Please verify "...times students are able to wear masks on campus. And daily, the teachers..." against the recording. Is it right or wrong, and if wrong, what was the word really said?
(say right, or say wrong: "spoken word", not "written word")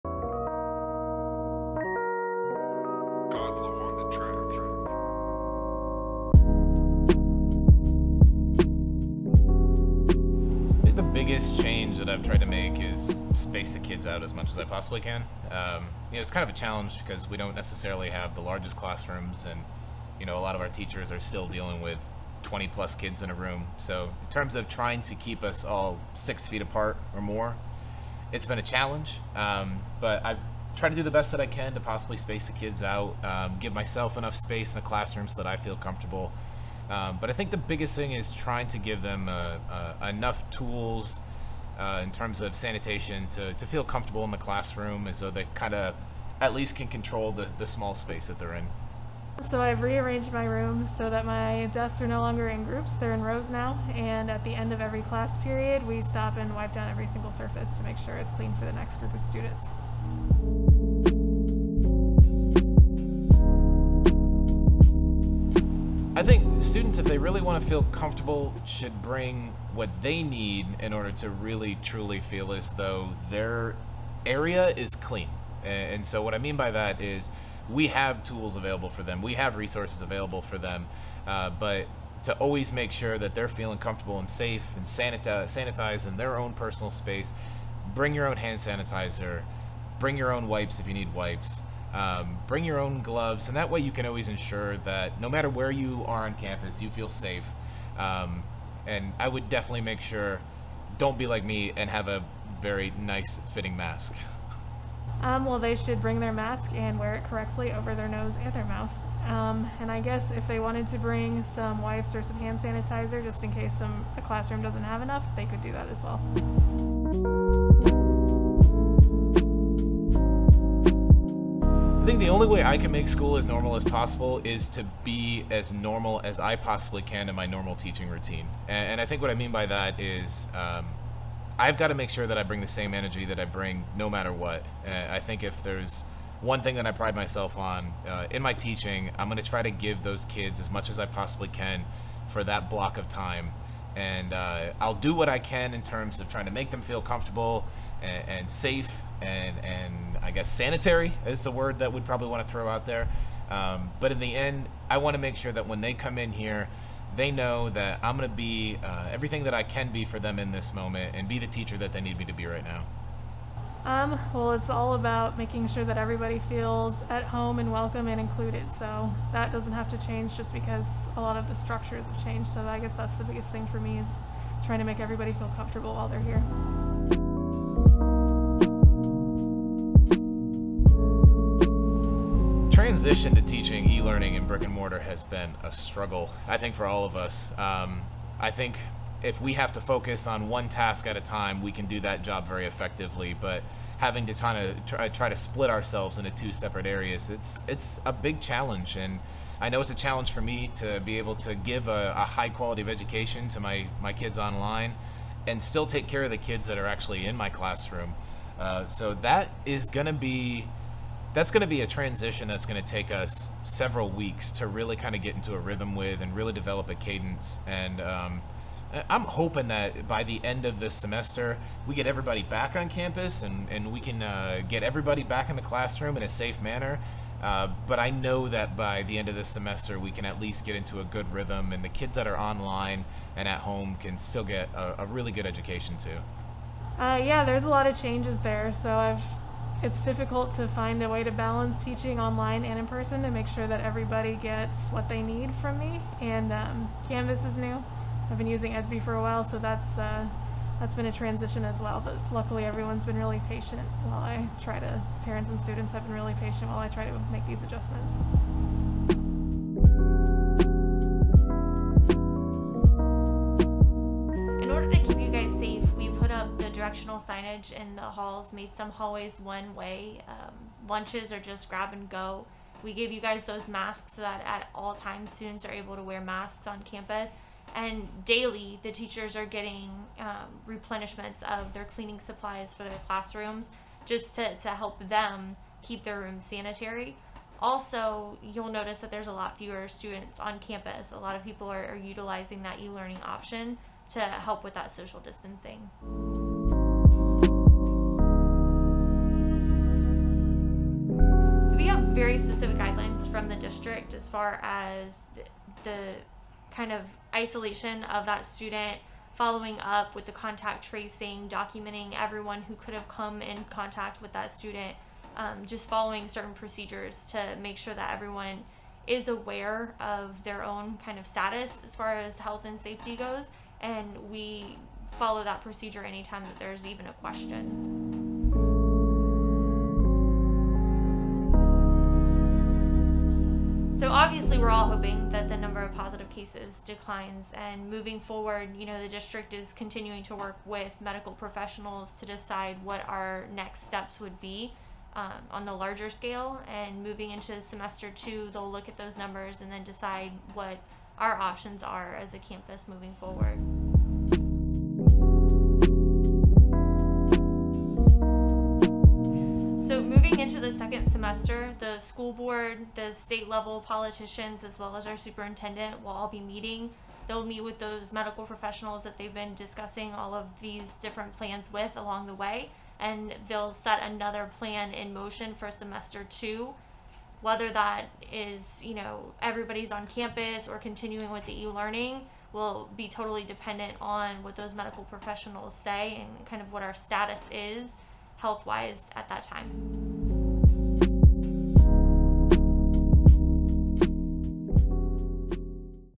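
right.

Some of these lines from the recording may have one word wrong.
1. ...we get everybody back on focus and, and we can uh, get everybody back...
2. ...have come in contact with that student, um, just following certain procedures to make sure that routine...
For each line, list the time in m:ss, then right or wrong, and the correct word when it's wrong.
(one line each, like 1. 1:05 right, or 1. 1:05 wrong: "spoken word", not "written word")
1. 3:41 wrong: "campus", not "focus"
2. 5:12 wrong: "everyone", not "routine".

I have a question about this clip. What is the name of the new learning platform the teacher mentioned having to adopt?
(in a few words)
Canvas.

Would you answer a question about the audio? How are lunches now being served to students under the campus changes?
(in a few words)
grab and go.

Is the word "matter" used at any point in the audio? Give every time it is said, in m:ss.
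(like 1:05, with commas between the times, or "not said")
1:35, 2:14.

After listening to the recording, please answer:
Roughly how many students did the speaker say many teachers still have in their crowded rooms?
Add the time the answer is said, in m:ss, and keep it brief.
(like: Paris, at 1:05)
20 plus, at 0:22.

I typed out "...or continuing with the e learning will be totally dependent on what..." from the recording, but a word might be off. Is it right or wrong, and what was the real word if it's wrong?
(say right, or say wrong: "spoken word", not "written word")
right.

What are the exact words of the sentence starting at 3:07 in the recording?
Um, I think if we have to focus on one task at a time, we can do that job very effectively.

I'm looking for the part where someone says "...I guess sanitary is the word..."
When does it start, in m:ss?
2:30.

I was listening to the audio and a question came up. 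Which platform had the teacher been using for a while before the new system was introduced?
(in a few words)
Edsby.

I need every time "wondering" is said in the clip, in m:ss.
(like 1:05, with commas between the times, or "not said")
not said.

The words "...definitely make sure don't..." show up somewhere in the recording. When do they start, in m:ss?
1:39.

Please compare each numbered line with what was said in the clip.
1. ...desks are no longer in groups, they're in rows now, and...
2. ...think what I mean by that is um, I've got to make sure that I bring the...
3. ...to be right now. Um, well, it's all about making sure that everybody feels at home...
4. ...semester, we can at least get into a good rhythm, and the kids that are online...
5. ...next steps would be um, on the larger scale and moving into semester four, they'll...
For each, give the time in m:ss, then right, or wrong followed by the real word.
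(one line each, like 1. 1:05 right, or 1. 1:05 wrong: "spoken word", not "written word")
1. 0:51 right
2. 2:09 right
3. 2:42 right
4. 3:49 right
5. 5:43 wrong: "two", not "four".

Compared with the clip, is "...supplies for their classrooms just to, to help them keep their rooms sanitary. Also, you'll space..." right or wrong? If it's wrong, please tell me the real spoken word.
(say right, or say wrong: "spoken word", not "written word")
wrong: "notice", not "space".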